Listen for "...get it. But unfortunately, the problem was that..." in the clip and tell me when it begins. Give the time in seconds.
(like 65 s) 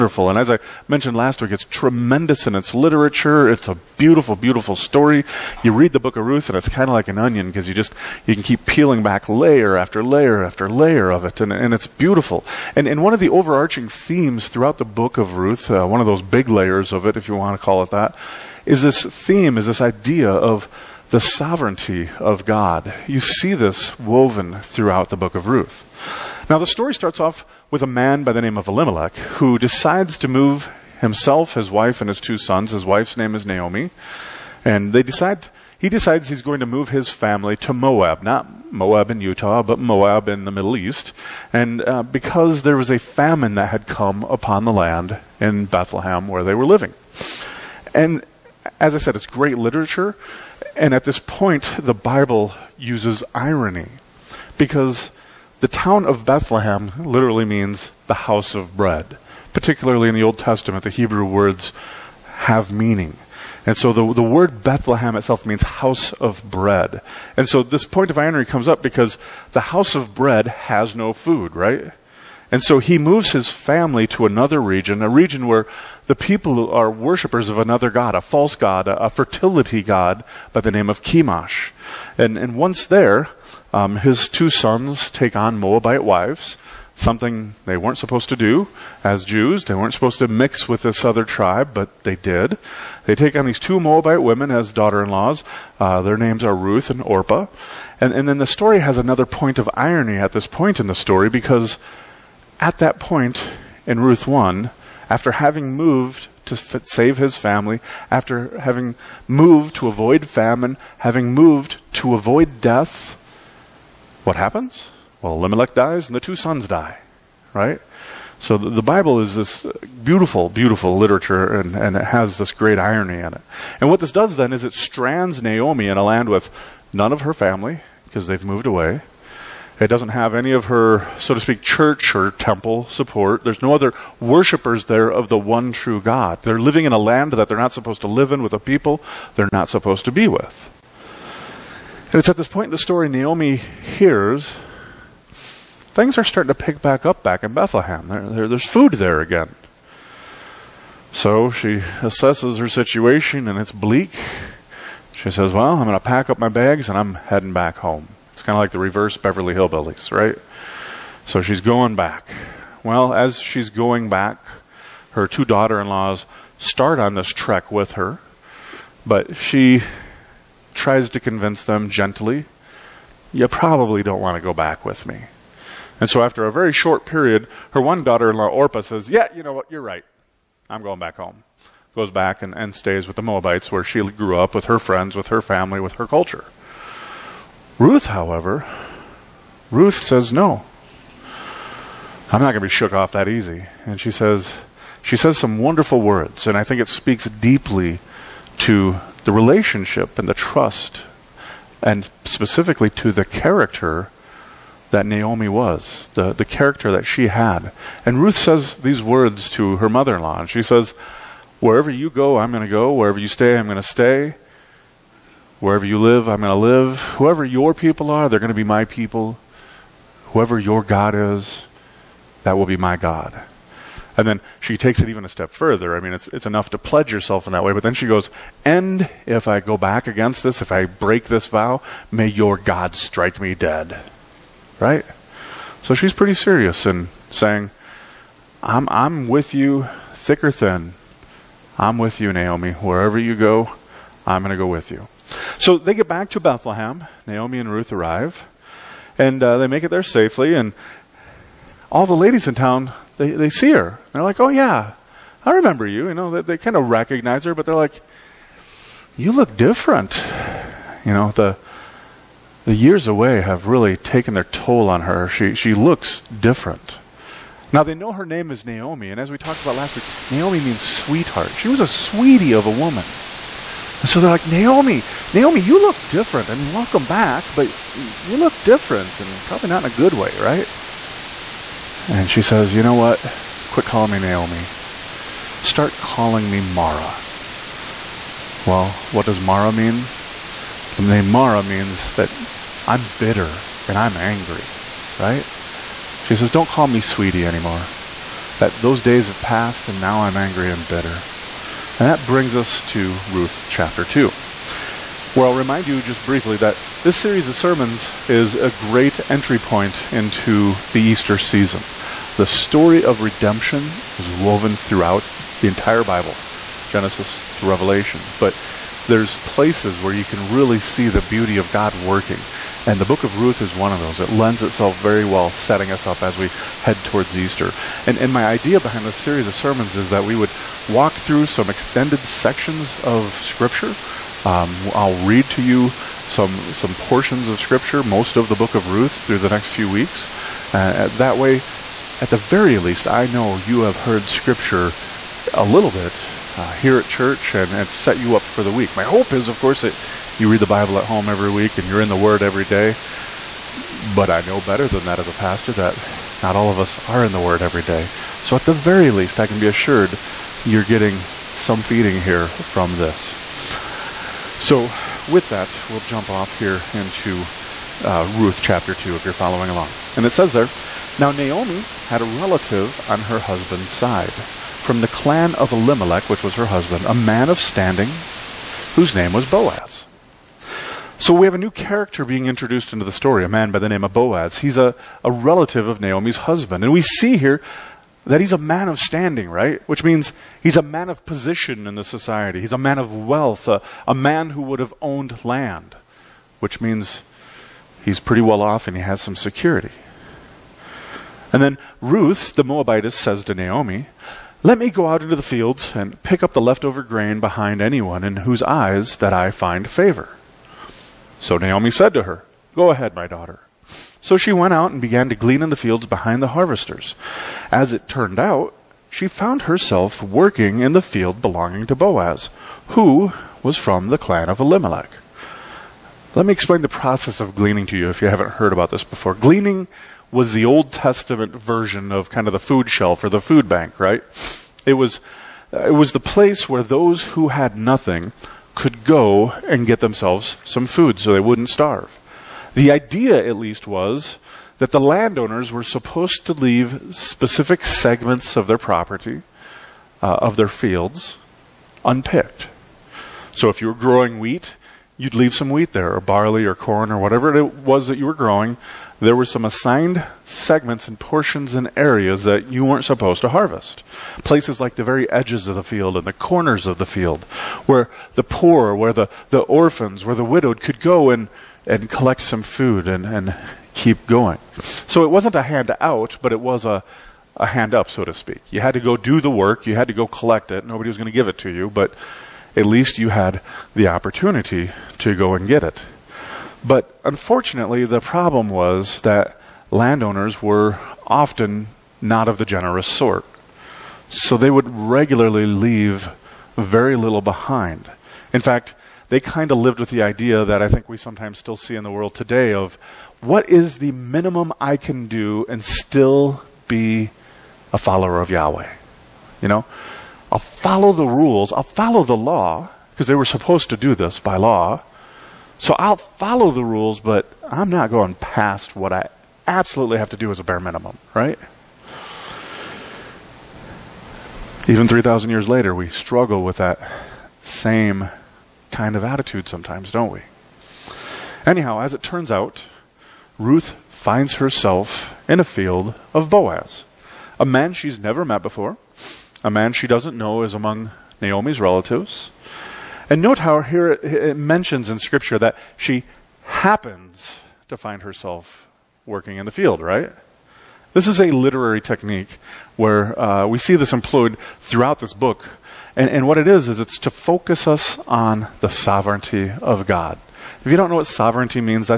485 s.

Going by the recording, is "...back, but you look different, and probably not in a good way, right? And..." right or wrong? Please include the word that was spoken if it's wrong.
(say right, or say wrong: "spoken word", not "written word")
right.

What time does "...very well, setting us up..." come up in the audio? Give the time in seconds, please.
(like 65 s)
325 s.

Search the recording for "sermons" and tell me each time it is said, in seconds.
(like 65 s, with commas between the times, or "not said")
307 s, 329 s.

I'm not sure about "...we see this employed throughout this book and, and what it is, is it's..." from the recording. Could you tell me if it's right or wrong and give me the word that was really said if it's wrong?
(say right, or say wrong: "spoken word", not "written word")
right.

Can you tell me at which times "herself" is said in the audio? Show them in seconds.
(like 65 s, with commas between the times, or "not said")
419 s, 534 s, 548 s.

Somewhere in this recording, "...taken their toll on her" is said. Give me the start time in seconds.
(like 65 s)
263 s.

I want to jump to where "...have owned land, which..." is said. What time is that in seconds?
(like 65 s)
394 s.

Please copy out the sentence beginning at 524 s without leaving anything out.
Even 3,000 years later, we struggle with that same kind of attitude sometimes, don't we?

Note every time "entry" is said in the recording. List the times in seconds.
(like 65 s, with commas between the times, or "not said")
309 s.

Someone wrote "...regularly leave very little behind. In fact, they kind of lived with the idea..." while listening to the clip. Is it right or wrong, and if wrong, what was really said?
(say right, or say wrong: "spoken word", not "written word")
right.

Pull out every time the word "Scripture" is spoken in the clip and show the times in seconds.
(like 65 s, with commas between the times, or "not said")
333 s, 337 s, 344 s, 545 s.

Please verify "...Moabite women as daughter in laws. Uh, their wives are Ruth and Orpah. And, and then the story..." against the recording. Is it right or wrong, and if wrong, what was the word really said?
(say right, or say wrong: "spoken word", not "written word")
wrong: "names", not "wives".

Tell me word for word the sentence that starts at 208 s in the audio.
And Ruth says these words to her mother in law.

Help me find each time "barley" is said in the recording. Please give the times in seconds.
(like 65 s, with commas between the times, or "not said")
456 s.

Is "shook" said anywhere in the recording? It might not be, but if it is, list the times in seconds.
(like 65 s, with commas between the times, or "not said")
192 s.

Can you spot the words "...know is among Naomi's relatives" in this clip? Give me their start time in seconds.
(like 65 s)
540 s.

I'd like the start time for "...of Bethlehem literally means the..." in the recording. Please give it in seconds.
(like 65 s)
56 s.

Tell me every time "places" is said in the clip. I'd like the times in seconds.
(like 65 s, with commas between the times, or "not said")
319 s, 436 s, 464 s.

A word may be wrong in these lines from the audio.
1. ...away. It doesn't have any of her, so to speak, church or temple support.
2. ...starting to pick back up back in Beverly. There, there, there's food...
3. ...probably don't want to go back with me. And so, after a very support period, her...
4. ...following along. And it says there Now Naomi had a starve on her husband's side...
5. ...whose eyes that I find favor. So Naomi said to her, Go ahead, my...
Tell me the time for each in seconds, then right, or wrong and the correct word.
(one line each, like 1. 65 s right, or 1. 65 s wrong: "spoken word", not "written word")
1. 128 s right
2. 146 s wrong: "Bethlehem", not "Beverly"
3. 173 s wrong: "short", not "support"
4. 369 s wrong: "relative", not "starve"
5. 408 s right.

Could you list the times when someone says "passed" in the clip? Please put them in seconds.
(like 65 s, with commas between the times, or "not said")
299 s.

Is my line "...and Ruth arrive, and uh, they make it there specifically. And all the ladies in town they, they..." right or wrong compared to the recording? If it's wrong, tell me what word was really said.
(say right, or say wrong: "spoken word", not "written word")
wrong: "safely", not "specifically".